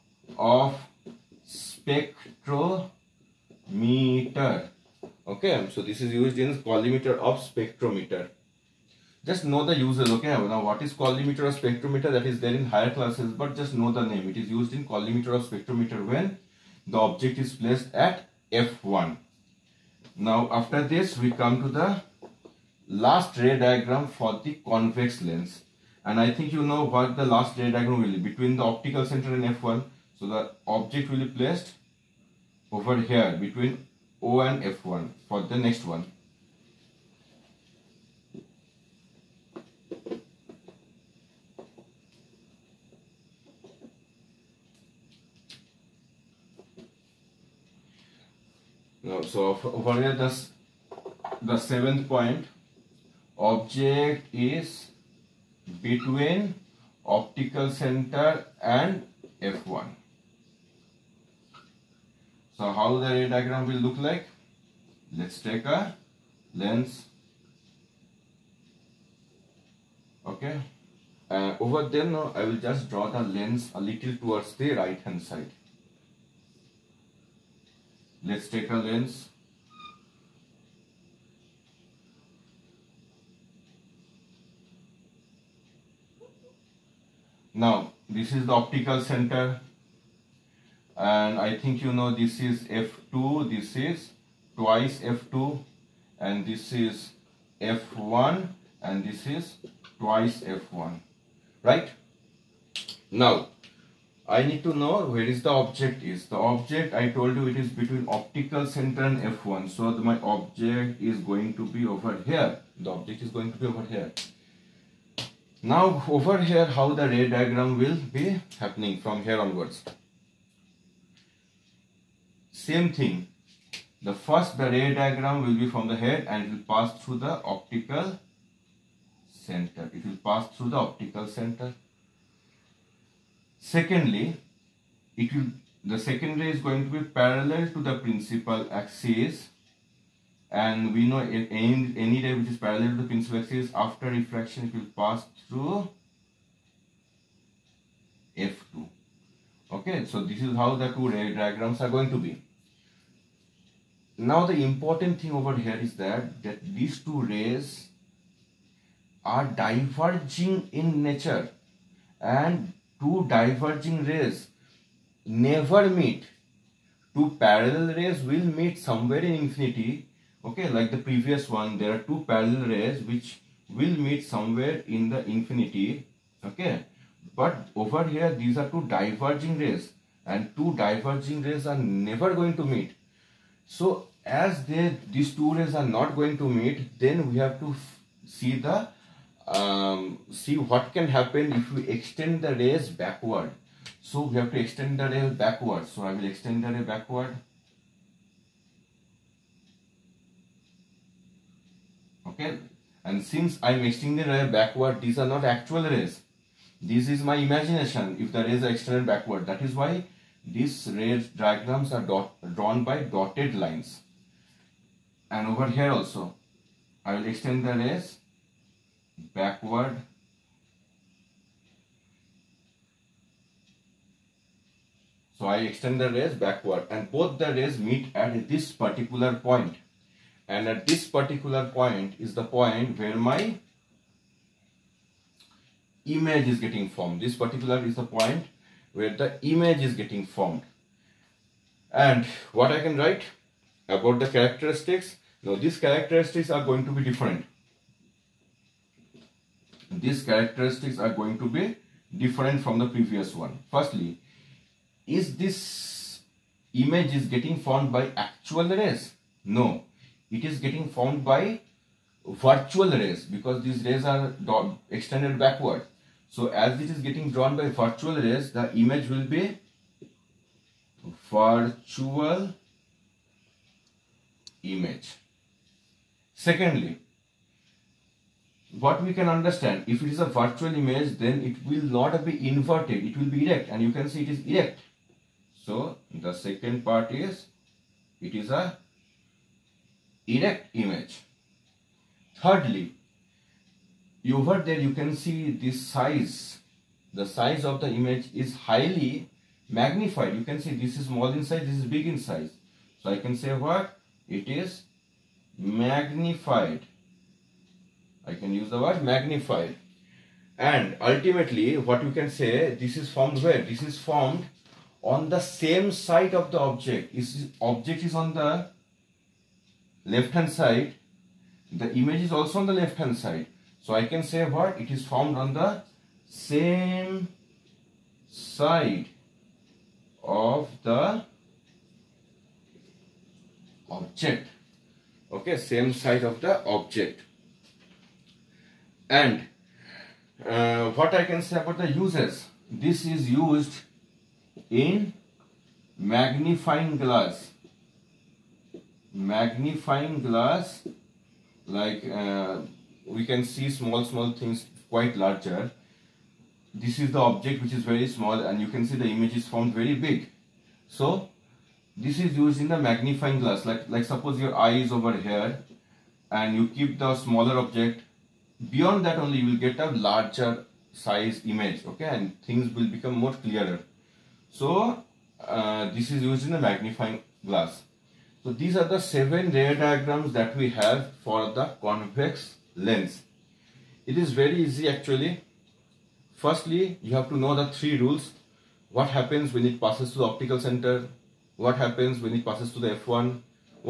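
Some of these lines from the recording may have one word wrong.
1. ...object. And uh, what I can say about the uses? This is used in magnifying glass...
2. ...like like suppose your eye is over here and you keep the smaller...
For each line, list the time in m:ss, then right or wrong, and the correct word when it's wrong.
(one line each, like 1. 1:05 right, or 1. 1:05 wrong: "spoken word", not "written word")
1. 5:36 right
2. 6:03 right.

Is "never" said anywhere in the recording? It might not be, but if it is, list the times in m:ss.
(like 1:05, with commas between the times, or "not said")
2:45, 3:01.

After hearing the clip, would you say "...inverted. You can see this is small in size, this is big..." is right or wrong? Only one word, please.
wrong.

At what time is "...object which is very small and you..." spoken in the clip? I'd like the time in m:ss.
5:57.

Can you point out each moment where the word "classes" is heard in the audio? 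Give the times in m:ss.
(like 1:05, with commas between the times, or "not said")
0:12.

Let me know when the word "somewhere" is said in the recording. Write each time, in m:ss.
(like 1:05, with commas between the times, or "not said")
2:48, 2:54.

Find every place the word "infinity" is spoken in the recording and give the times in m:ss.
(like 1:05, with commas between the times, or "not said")
2:49, 2:55.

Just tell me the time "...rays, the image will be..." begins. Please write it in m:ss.
4:28.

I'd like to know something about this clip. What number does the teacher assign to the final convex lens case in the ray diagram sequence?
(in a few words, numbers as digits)
7.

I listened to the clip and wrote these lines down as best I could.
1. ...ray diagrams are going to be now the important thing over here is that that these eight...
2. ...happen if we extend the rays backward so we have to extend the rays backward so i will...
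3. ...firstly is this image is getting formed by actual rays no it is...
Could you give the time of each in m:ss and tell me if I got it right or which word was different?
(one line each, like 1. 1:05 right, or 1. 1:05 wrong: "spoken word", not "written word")
1. 2:31 wrong: "two", not "eight"
2. 3:11 right
3. 4:13 right.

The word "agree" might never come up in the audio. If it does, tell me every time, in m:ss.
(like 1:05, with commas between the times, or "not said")
not said.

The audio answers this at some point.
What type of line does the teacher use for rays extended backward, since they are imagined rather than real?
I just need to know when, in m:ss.
3:33.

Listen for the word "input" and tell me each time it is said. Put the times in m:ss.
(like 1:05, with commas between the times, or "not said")
not said.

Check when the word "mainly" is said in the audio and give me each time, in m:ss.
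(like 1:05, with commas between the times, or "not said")
not said.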